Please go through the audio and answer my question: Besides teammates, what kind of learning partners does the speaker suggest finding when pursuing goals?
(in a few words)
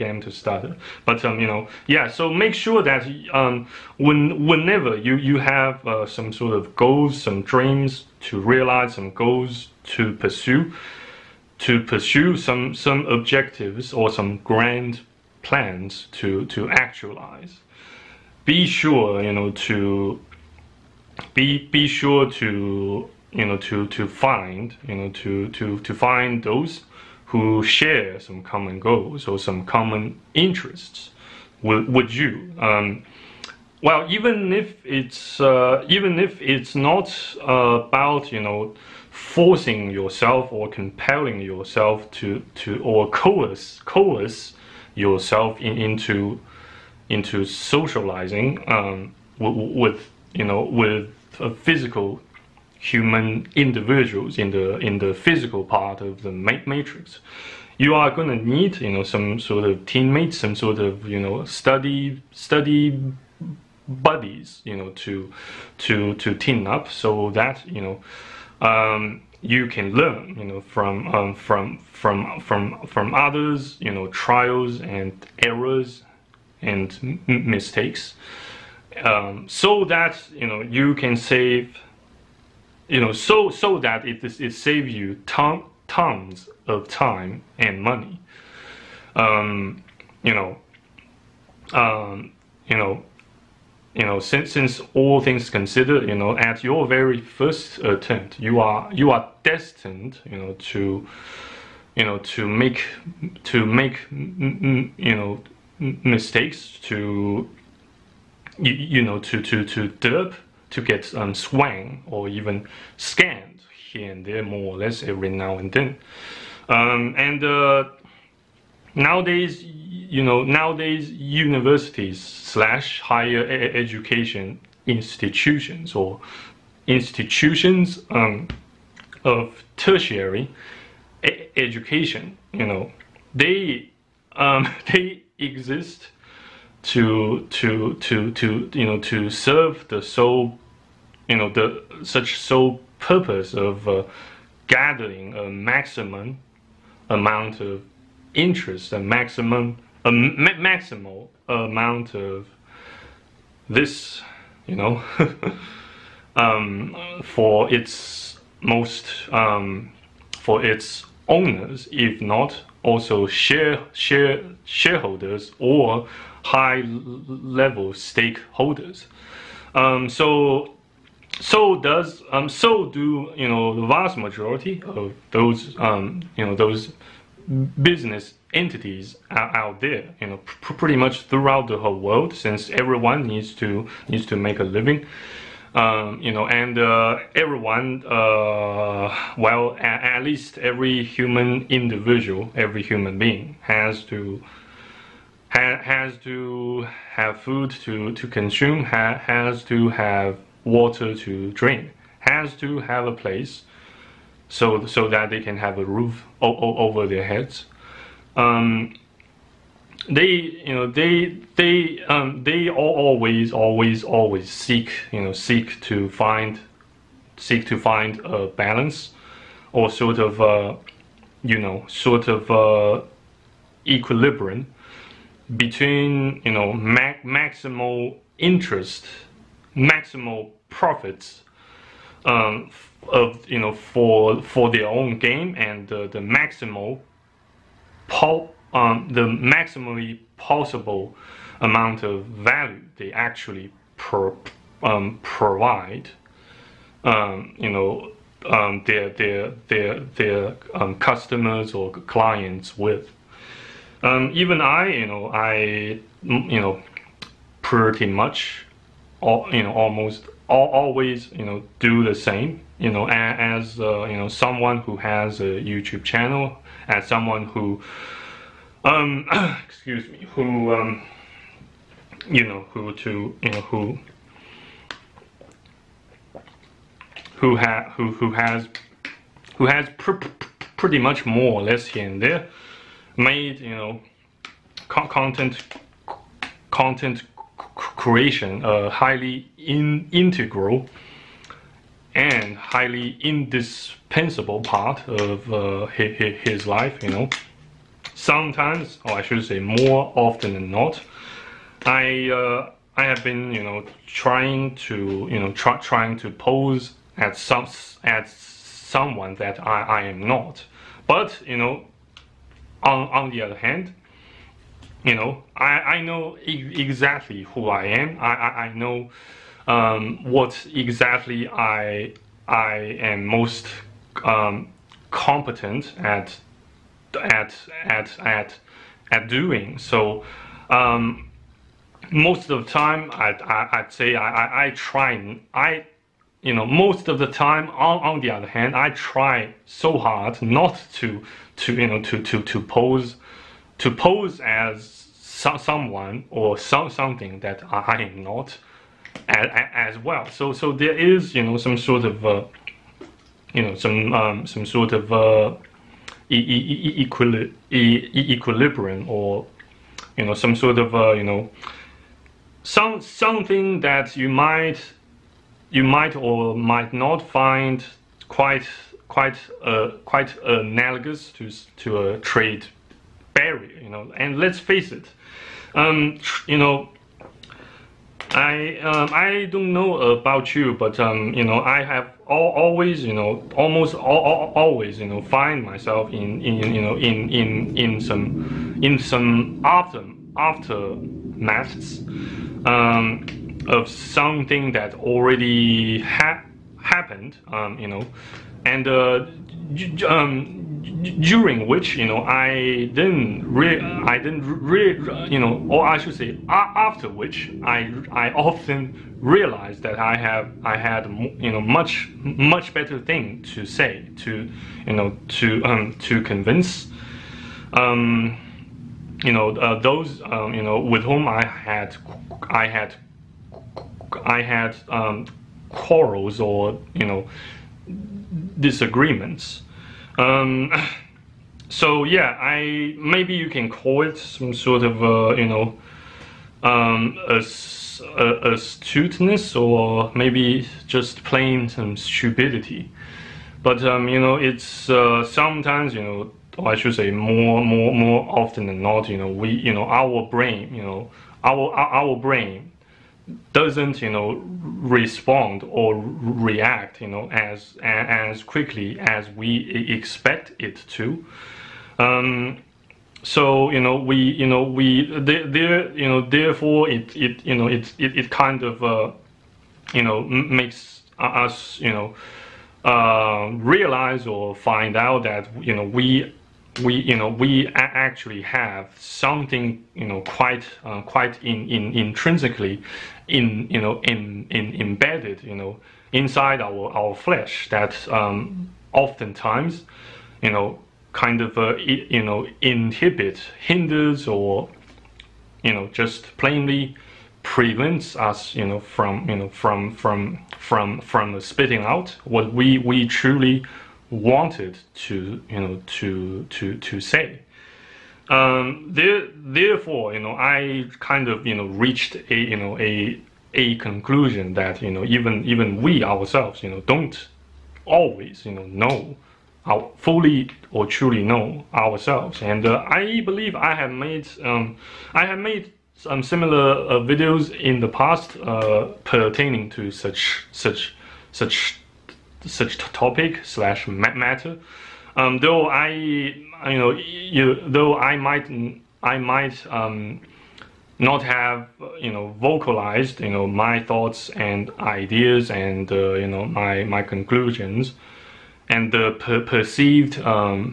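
study buddies.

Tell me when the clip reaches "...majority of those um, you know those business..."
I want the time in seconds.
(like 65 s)
174 s.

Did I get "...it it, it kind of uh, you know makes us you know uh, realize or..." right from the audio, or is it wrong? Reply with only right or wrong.
right.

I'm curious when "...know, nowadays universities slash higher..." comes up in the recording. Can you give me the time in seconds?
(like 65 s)
120 s.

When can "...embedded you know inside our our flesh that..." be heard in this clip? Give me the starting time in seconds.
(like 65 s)
484 s.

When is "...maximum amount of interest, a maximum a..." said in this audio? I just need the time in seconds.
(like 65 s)
145 s.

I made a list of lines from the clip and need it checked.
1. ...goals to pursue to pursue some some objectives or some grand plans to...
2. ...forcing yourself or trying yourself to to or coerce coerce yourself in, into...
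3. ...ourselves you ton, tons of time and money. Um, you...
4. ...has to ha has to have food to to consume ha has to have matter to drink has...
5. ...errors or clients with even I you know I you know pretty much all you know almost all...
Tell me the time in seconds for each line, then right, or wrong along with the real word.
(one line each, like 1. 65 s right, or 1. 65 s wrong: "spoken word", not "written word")
1. 9 s right
2. 39 s wrong: "compelling", not "trying"
3. 84 s wrong: "saves", not "ourselves"
4. 193 s wrong: "water", not "matter"
5. 250 s wrong: "customers", not "errors".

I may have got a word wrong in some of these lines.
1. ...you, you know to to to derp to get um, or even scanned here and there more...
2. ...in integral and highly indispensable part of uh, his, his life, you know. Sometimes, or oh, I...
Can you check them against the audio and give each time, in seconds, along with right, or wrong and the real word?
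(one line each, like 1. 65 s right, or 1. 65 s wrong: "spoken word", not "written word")
1. 108 s right
2. 289 s right.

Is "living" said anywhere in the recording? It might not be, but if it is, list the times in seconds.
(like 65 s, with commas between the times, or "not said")
184 s.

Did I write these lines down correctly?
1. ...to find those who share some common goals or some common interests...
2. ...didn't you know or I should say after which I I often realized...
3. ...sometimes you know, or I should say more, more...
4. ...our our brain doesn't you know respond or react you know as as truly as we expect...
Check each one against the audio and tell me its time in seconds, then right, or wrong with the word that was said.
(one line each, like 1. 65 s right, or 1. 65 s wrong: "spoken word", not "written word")
1. 25 s right
2. 404 s right
3. 445 s right
4. 451 s wrong: "quickly", not "truly".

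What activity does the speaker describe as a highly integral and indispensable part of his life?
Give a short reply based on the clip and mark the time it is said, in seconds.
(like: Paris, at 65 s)
content creation, at 284 s.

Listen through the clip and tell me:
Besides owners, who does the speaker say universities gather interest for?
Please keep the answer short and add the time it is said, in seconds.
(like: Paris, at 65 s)
shareholders, at 163 s.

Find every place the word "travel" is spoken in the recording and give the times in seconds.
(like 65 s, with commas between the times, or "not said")
not said.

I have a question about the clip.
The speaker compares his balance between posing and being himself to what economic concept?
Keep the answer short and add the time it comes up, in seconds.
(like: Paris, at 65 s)
trade barrier, at 372 s.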